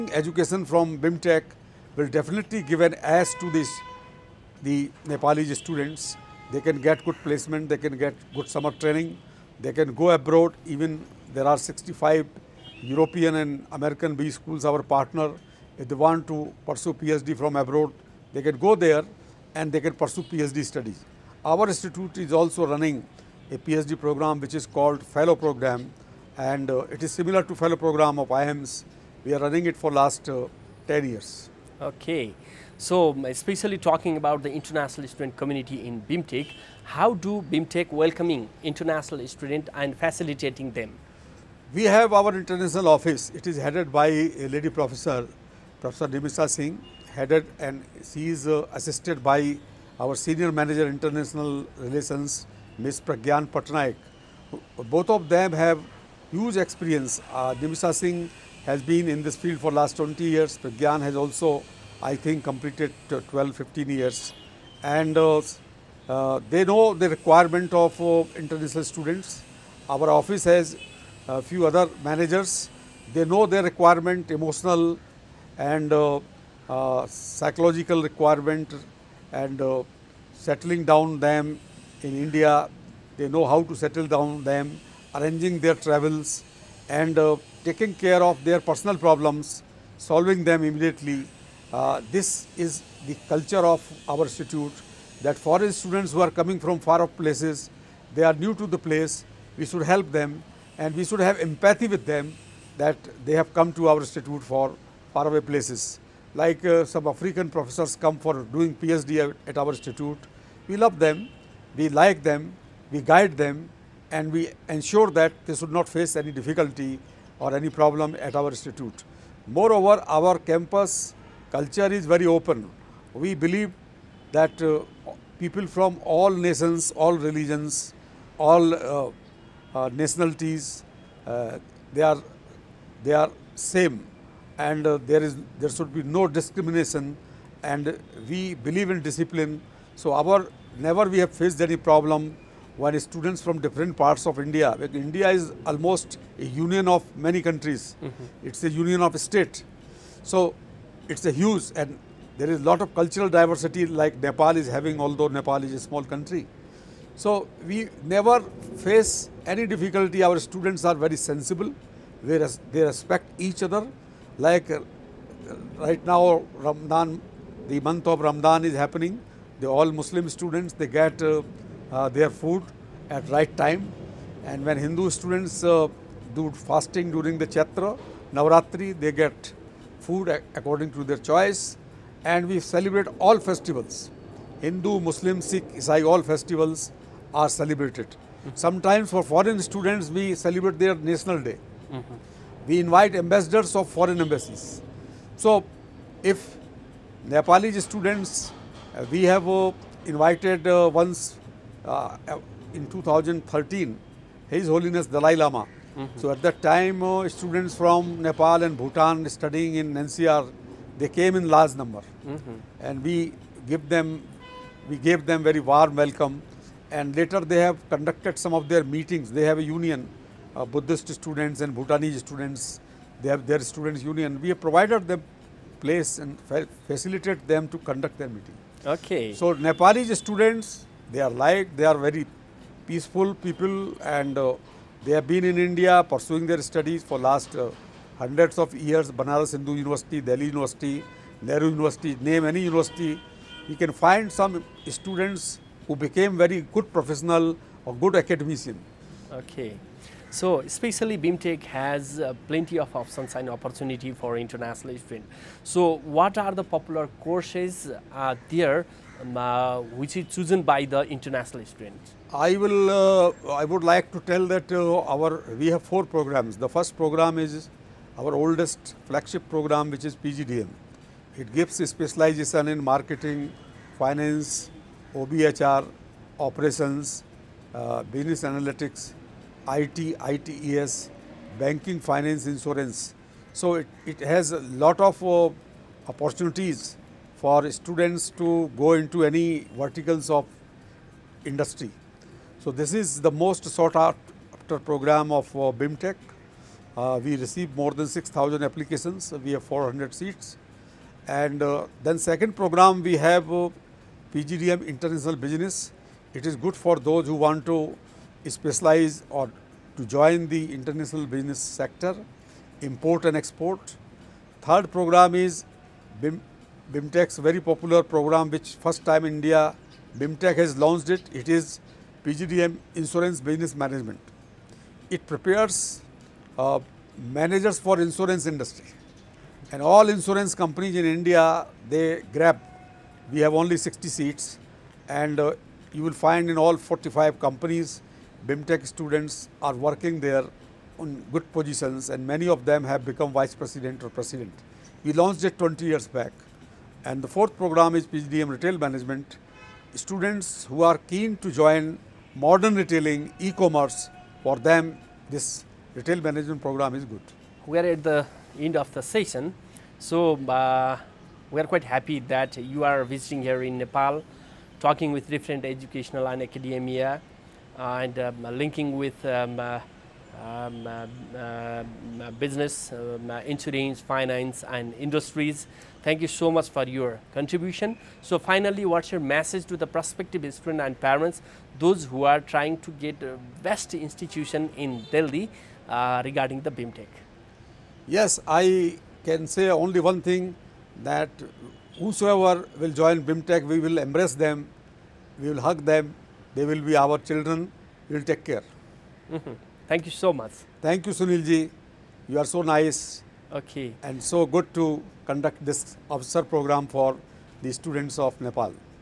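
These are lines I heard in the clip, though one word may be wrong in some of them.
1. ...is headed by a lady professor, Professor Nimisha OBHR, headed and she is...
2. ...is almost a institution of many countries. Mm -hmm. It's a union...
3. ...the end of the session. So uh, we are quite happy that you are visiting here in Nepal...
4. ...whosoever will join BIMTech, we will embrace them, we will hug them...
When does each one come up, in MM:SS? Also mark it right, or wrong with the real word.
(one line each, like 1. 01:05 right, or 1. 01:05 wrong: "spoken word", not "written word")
1. 00:43 wrong: "Singh", not "OBHR"
2. 02:25 wrong: "union", not "institution"
3. 05:58 right
4. 06:31 right.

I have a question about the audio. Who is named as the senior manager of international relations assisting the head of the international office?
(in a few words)
Pragyan Patnaik.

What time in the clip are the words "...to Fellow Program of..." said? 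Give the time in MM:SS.
00:27.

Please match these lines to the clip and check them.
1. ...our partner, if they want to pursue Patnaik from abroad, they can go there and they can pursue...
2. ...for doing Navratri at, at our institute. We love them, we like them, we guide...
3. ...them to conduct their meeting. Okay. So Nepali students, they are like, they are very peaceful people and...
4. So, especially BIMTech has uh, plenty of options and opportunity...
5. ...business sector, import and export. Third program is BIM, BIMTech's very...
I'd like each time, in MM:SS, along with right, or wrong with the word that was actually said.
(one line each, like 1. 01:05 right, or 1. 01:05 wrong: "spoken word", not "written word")
1. 00:14 wrong: "PhD", not "Patnaik"
2. 01:48 wrong: "PhD", not "Navratri"
3. 03:47 right
4. 04:10 right
5. 05:11 right.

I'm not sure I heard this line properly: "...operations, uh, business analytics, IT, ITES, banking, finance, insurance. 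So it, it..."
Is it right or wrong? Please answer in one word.
right.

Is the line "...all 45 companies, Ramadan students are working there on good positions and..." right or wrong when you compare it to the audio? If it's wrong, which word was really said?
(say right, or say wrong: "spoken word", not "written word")
wrong: "BIMTech", not "Ramadan".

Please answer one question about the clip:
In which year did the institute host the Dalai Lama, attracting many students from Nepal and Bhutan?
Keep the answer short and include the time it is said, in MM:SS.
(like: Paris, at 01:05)
2013, at 03:22.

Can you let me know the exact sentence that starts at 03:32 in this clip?
and we give them, we gave them very warm welcome and later they have conducted some of their meetings.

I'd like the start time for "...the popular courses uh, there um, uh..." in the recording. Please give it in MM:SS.
04:16.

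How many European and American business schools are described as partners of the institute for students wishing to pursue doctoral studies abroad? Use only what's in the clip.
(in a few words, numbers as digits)
65.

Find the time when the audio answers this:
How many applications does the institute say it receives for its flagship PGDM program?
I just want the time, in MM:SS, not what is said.
04:57.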